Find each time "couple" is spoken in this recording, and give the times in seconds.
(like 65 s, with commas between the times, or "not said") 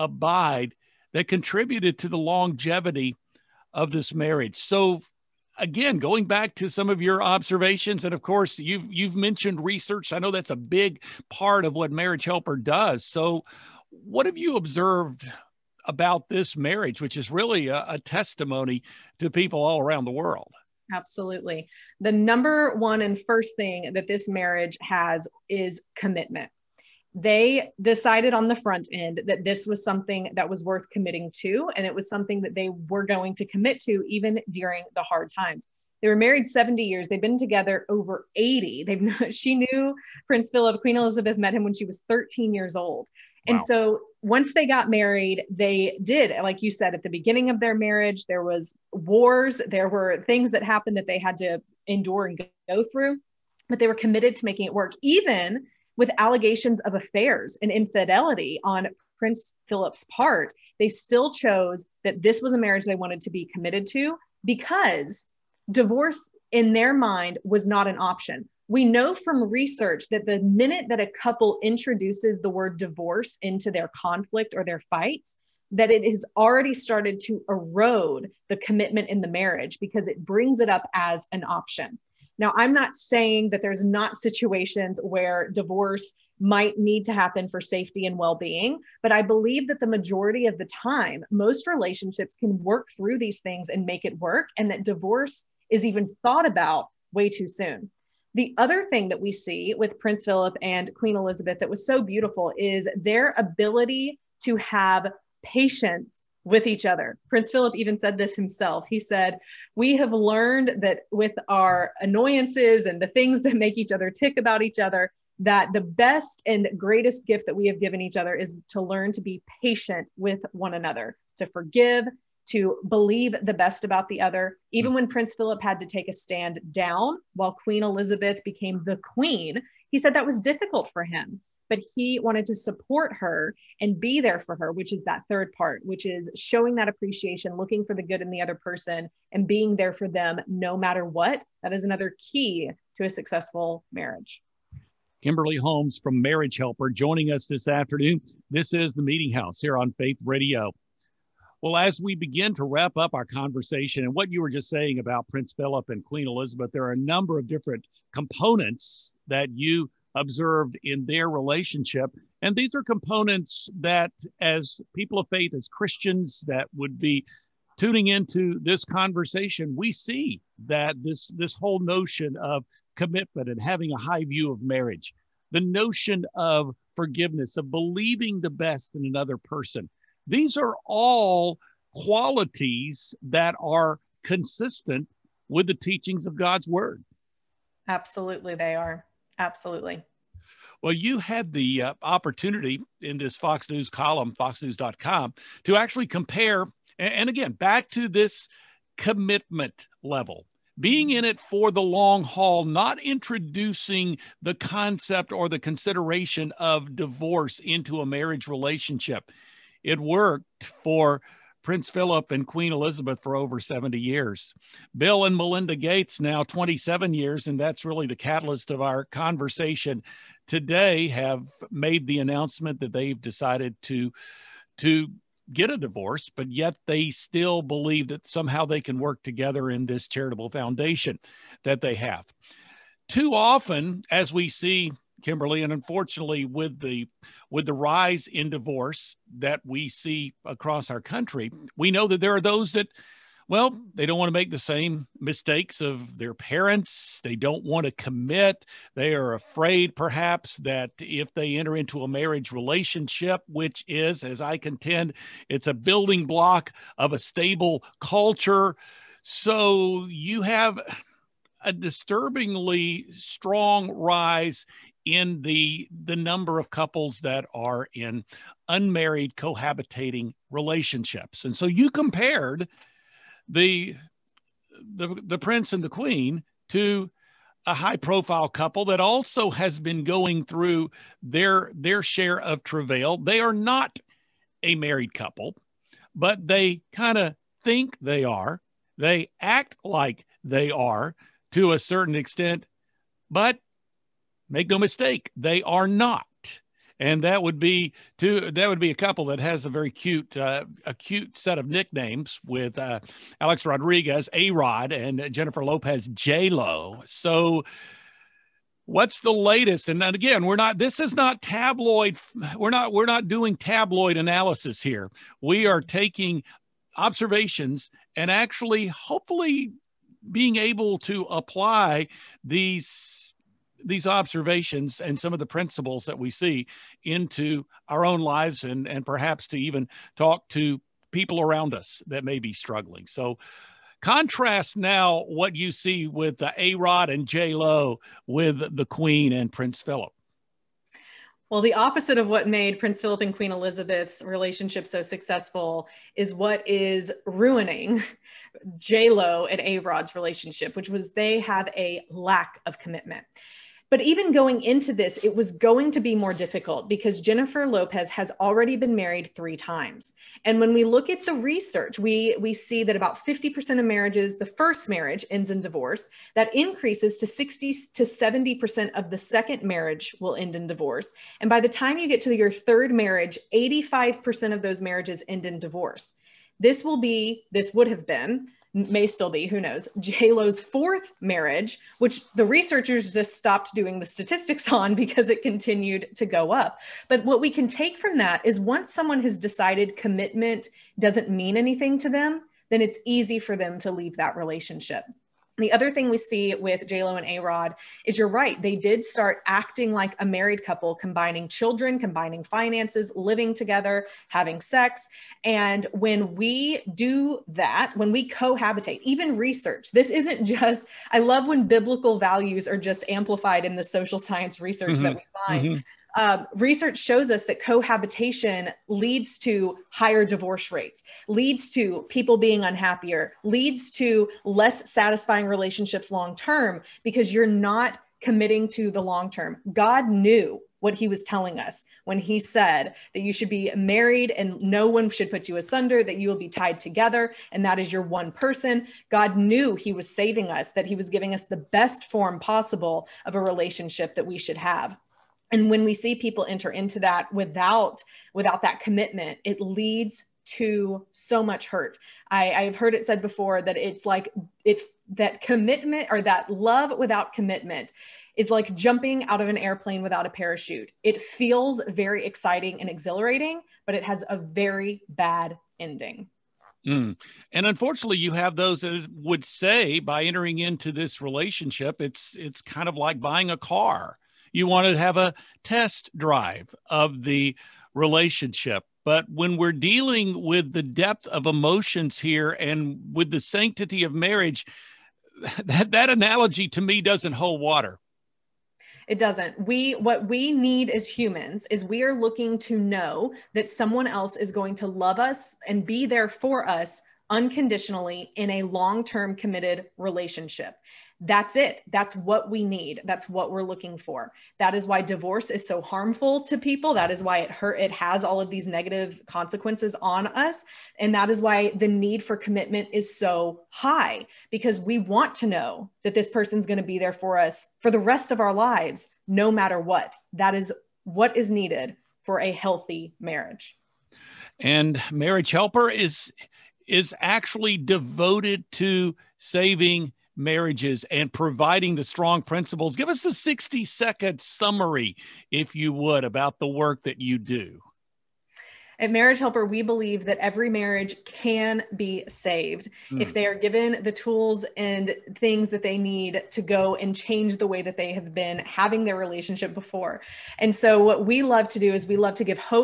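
71 s, 266 s, 278 s, 285 s, 298 s, 400 s.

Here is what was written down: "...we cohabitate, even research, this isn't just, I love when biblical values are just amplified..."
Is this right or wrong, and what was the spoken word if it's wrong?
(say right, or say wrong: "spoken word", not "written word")
right.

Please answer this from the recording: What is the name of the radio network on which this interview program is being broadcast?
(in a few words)
Faith Radio.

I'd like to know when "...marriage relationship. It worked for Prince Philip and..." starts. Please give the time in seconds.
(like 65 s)
208 s.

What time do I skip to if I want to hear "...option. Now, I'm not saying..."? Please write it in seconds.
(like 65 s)
81 s.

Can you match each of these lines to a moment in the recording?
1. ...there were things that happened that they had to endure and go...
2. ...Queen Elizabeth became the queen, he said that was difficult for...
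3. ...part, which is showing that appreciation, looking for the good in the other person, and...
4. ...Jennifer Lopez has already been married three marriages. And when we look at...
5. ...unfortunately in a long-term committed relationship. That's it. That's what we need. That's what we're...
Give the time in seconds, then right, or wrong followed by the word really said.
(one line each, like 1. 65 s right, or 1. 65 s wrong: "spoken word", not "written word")
1. 49 s right
2. 127 s right
3. 135 s right
4. 357 s wrong: "times", not "marriages"
5. 497 s wrong: "unconditionally", not "unfortunately".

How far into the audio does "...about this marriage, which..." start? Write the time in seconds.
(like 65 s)
15 s.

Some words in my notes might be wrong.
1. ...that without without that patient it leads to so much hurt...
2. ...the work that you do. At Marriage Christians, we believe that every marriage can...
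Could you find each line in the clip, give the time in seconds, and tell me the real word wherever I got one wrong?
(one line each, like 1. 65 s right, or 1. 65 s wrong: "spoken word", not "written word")
1. 447 s wrong: "commitment", not "patient"
2. 536 s wrong: "Helper", not "Christians".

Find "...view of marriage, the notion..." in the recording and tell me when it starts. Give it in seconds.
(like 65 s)
174 s.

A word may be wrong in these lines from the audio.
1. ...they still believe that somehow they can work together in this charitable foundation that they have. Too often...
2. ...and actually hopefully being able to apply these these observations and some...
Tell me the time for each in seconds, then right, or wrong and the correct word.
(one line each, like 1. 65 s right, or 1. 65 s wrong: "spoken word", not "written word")
1. 226 s right
2. 318 s right.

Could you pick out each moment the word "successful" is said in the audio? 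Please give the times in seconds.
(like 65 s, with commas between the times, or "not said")
143 s, 345 s.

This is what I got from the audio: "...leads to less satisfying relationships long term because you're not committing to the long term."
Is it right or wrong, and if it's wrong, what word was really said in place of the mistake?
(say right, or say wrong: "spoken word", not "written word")
right.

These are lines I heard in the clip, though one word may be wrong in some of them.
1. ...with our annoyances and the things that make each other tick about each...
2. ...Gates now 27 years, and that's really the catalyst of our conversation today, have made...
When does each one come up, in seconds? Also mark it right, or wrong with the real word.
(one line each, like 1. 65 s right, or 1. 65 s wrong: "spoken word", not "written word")
1. 111 s right
2. 215 s right.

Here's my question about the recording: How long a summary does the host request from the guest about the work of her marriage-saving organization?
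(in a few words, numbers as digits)
60 seconds.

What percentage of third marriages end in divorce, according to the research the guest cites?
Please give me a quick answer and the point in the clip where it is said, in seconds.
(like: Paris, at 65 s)
85%, at 373 s.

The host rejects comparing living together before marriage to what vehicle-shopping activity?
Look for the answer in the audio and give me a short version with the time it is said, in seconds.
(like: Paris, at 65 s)
test drive, at 475 s.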